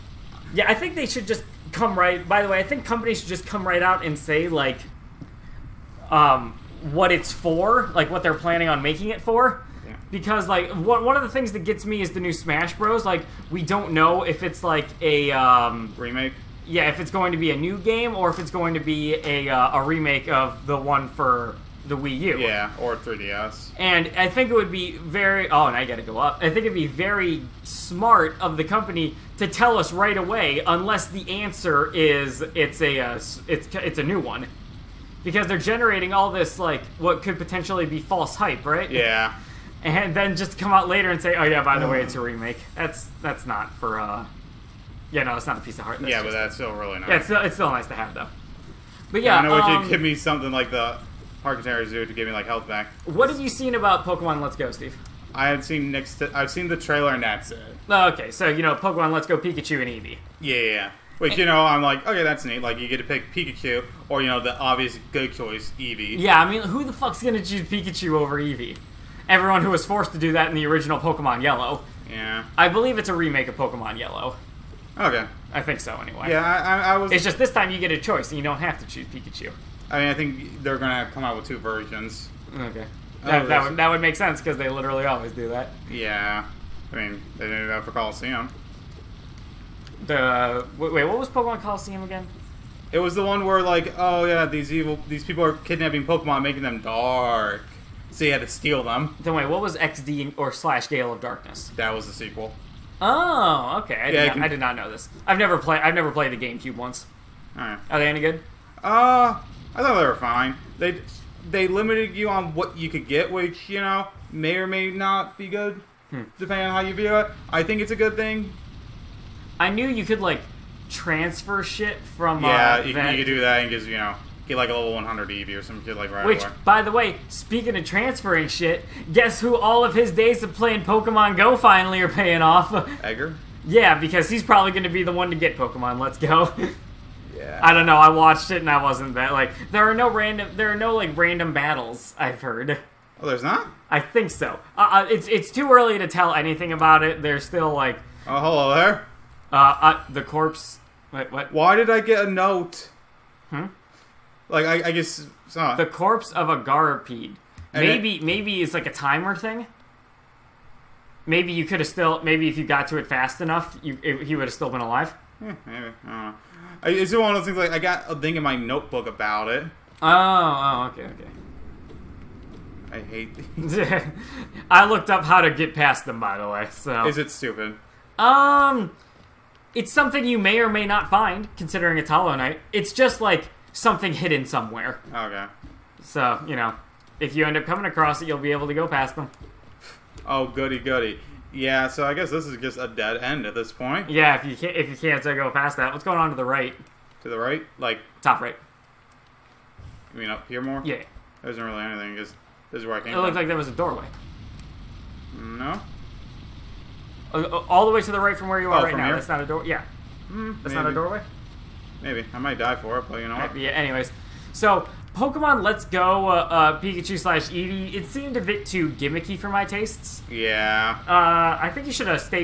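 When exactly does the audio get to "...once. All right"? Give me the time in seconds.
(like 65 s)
106 s.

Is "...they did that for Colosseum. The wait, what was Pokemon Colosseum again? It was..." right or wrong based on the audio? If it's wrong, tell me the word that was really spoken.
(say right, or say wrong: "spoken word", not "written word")
right.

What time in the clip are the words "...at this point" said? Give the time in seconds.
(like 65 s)
193 s.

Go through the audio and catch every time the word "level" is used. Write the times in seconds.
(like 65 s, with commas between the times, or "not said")
124 s.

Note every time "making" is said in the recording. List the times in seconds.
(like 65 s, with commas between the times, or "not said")
8 s, 96 s.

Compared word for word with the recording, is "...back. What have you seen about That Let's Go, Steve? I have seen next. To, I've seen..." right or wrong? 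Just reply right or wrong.
wrong.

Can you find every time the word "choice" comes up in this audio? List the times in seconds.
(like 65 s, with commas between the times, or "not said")
65 s, 77 s.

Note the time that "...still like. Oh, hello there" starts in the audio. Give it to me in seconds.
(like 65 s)
147 s.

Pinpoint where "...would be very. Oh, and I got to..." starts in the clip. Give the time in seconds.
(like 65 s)
24 s.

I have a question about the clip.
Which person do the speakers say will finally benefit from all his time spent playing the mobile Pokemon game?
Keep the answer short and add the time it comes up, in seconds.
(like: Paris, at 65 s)
Edgar, at 133 s.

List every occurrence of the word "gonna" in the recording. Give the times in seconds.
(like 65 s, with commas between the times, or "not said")
67 s, 80 s.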